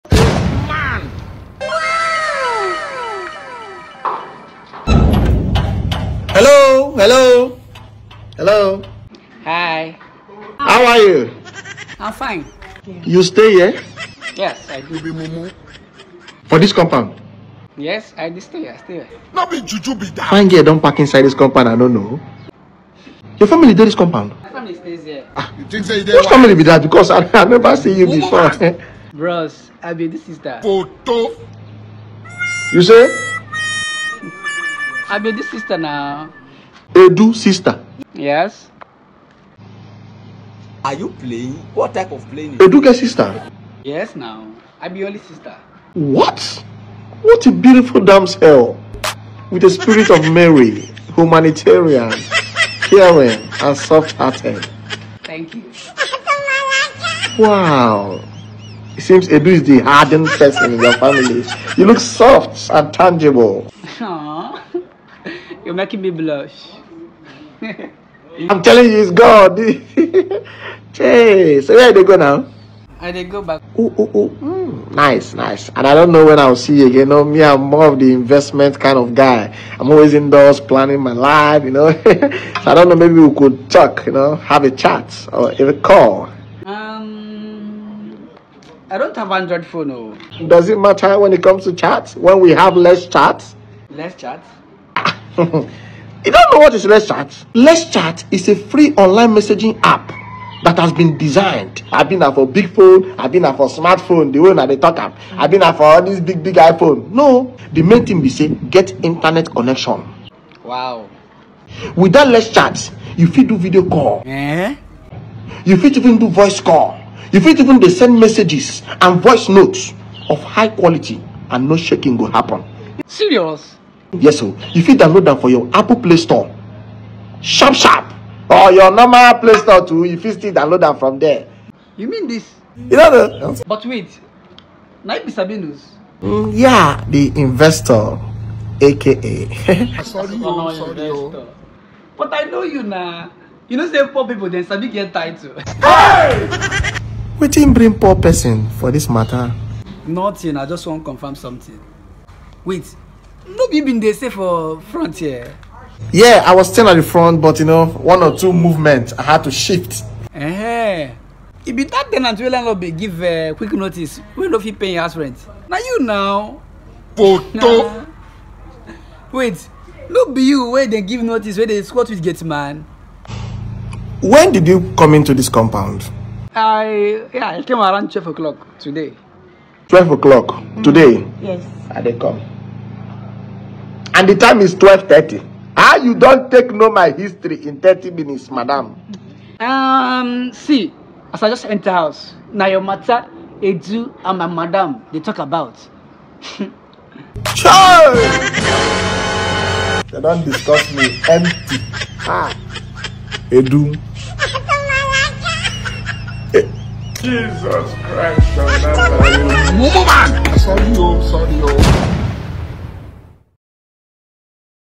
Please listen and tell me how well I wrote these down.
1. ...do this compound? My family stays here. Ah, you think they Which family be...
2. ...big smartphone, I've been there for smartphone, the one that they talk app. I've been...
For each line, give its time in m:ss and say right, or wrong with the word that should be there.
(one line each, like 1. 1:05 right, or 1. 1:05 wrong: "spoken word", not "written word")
1. 0:23 right
2. 1:42 wrong: "phone", not "smartphone".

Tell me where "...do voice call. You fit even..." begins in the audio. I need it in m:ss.
1:56.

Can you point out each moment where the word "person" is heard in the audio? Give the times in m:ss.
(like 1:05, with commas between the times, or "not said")
1:00, 2:28.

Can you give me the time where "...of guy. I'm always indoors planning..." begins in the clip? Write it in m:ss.
1:18.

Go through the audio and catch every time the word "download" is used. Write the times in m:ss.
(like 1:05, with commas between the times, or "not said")
2:04, 2:10.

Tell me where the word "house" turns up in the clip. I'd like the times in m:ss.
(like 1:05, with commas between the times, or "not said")
2:45, 3:11.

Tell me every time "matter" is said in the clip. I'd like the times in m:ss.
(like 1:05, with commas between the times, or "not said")
1:30, 2:29, 3:12.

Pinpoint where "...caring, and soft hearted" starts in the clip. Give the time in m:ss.
0:52.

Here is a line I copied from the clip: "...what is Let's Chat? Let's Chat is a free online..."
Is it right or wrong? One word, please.
right.